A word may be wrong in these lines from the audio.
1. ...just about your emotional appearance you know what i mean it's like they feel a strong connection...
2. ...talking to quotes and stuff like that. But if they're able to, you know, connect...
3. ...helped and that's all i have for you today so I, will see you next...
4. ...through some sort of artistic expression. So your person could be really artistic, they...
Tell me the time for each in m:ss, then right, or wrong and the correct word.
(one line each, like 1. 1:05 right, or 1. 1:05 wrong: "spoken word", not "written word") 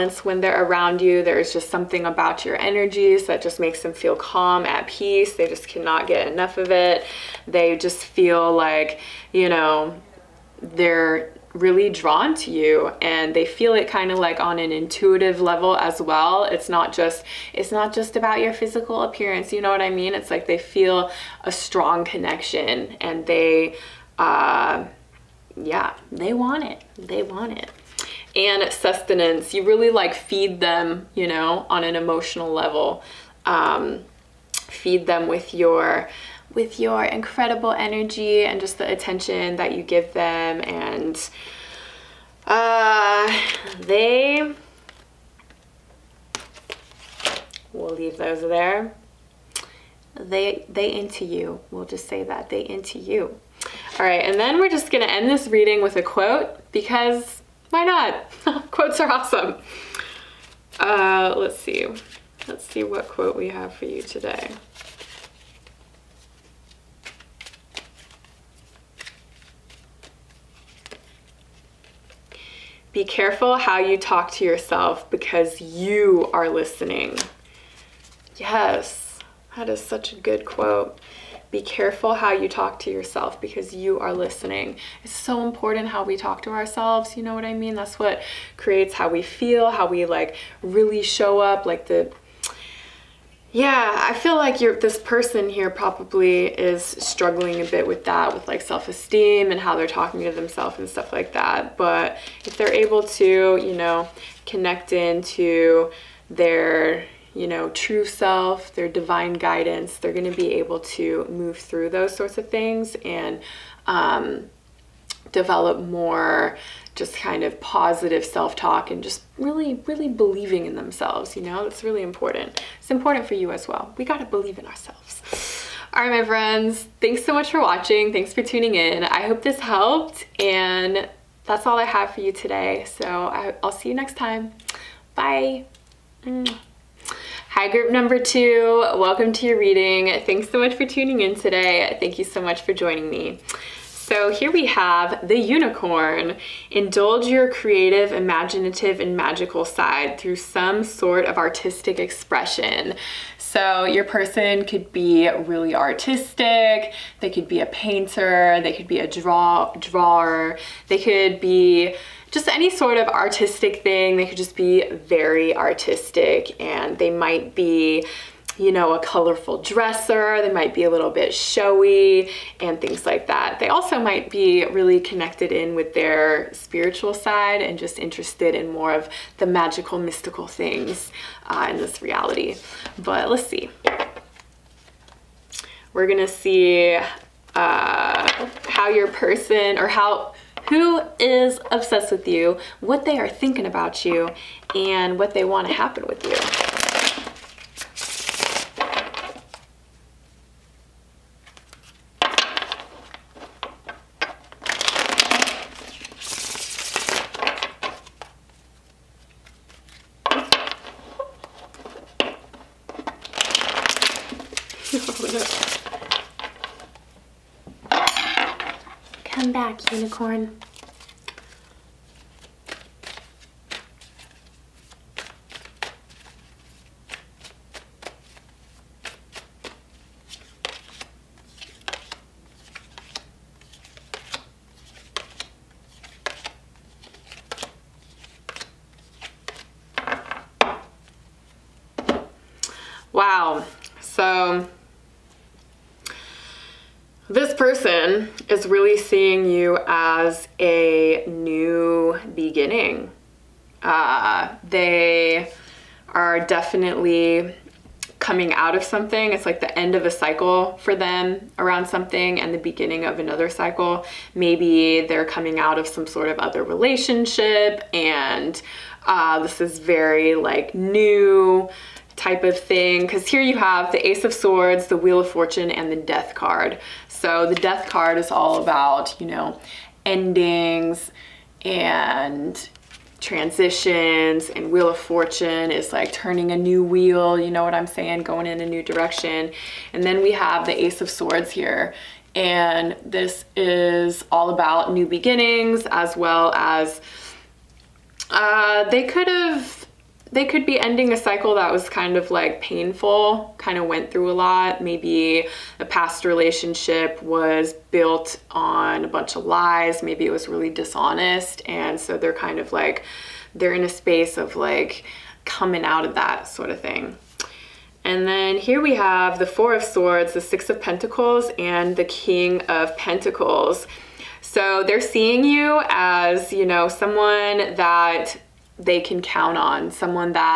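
1. 0:17 wrong: "physical", not "emotional"
2. 1:39 wrong: "themselves", not "quotes"
3. 2:09 right
4. 2:30 right.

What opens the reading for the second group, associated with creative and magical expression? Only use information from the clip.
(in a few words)
The unicorn.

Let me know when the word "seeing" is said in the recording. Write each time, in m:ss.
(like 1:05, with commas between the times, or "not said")
4:09, 5:24.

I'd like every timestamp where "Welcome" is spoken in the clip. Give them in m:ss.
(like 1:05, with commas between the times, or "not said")
2:18.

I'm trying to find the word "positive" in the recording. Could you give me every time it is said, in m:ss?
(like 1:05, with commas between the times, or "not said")
1:57.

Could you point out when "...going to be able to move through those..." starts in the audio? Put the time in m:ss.
1:50.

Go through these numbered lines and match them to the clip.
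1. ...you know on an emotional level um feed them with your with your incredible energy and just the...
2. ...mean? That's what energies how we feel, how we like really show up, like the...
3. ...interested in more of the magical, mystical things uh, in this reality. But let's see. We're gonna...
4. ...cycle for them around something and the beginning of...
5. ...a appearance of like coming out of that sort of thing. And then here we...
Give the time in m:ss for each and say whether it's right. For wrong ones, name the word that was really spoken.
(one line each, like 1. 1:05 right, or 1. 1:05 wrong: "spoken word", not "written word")
1. 0:31 right
2. 1:27 wrong: "creates", not "energies"
3. 2:57 right
4. 4:20 right
5. 5:13 wrong: "space", not "appearance".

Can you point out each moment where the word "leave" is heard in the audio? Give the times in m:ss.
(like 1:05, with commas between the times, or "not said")
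0:47.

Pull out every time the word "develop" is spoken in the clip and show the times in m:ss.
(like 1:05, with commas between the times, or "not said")
1:55.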